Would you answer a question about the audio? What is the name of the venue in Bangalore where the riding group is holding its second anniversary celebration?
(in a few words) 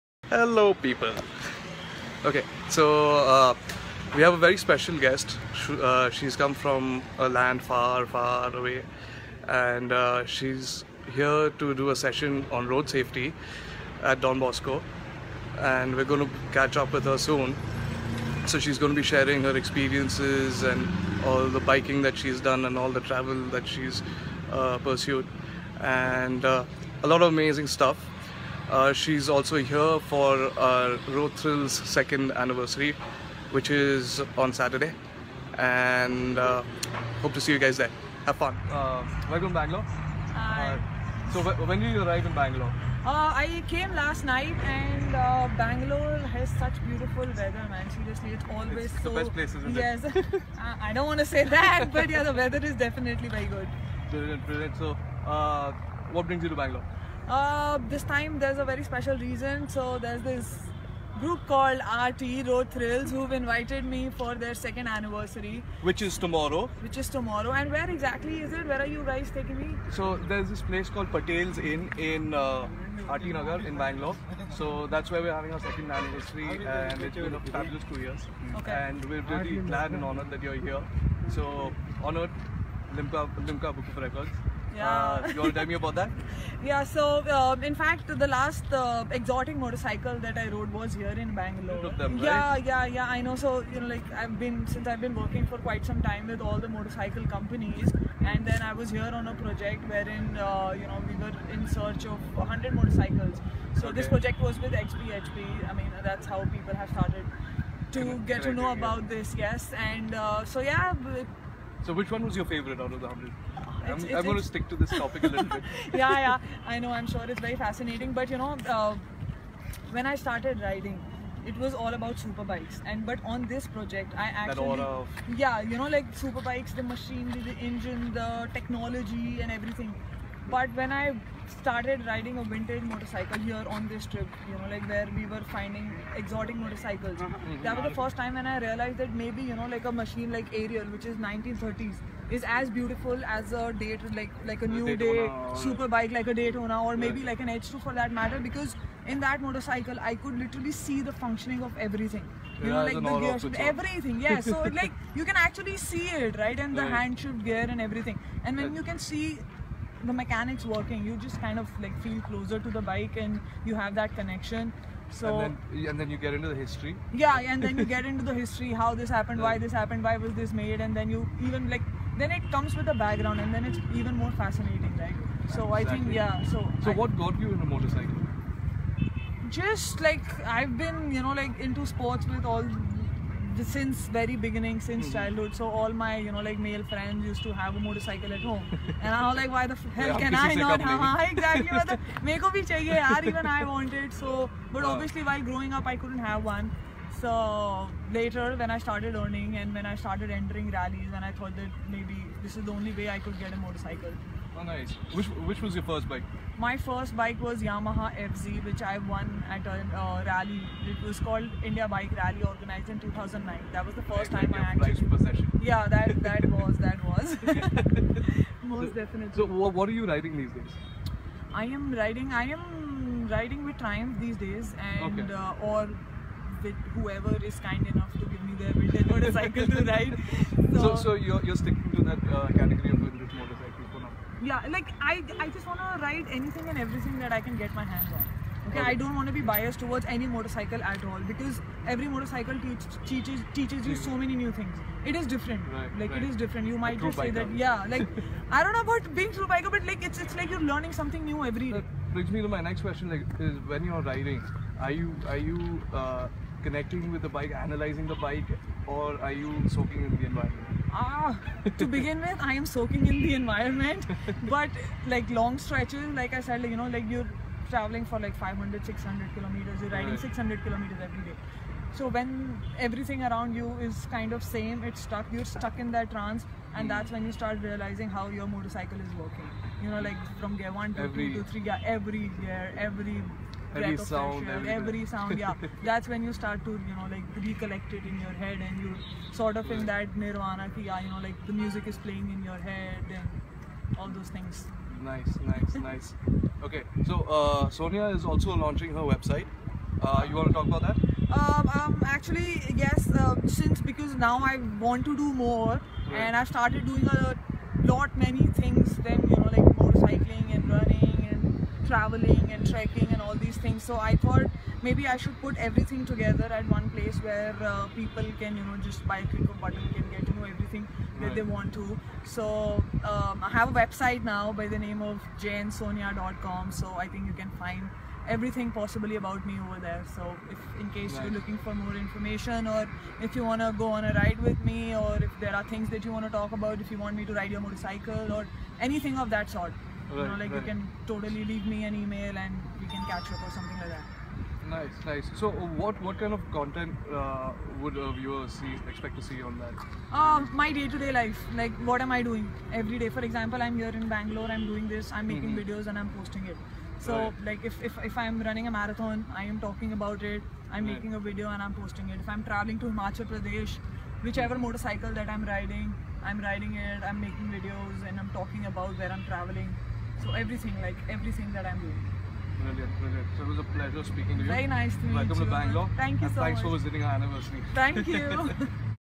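Patel's Inn.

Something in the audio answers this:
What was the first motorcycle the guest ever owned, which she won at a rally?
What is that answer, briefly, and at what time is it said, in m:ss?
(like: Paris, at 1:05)
Yamaha FZ, at 3:27.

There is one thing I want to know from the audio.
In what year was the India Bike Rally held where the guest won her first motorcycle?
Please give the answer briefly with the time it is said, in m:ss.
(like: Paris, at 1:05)
2009, at 3:32.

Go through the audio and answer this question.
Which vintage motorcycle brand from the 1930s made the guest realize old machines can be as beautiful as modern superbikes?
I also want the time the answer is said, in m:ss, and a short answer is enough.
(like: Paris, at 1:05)
Ariel, at 2:20.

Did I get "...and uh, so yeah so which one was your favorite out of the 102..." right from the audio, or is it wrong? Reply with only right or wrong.
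wrong.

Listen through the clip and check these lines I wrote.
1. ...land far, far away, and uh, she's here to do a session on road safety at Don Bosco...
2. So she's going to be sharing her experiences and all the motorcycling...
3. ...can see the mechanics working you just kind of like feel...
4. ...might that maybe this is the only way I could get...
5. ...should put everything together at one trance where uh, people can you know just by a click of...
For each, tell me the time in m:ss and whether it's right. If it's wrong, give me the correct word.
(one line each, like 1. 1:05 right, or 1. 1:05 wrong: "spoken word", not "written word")
1. 0:07 right
2. 0:18 wrong: "biking", not "motorcycling"
3. 2:38 right
4. 3:21 wrong: "thought", not "might"
5. 5:15 wrong: "place", not "trance".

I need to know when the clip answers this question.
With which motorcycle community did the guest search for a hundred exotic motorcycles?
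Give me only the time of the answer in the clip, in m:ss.
1:44.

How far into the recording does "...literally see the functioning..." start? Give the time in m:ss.
2:30.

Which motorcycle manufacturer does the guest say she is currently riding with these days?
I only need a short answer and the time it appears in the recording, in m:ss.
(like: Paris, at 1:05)
Triumph, at 3:43.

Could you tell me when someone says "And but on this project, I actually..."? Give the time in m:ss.
2:02.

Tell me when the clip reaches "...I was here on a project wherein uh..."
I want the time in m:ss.
1:38.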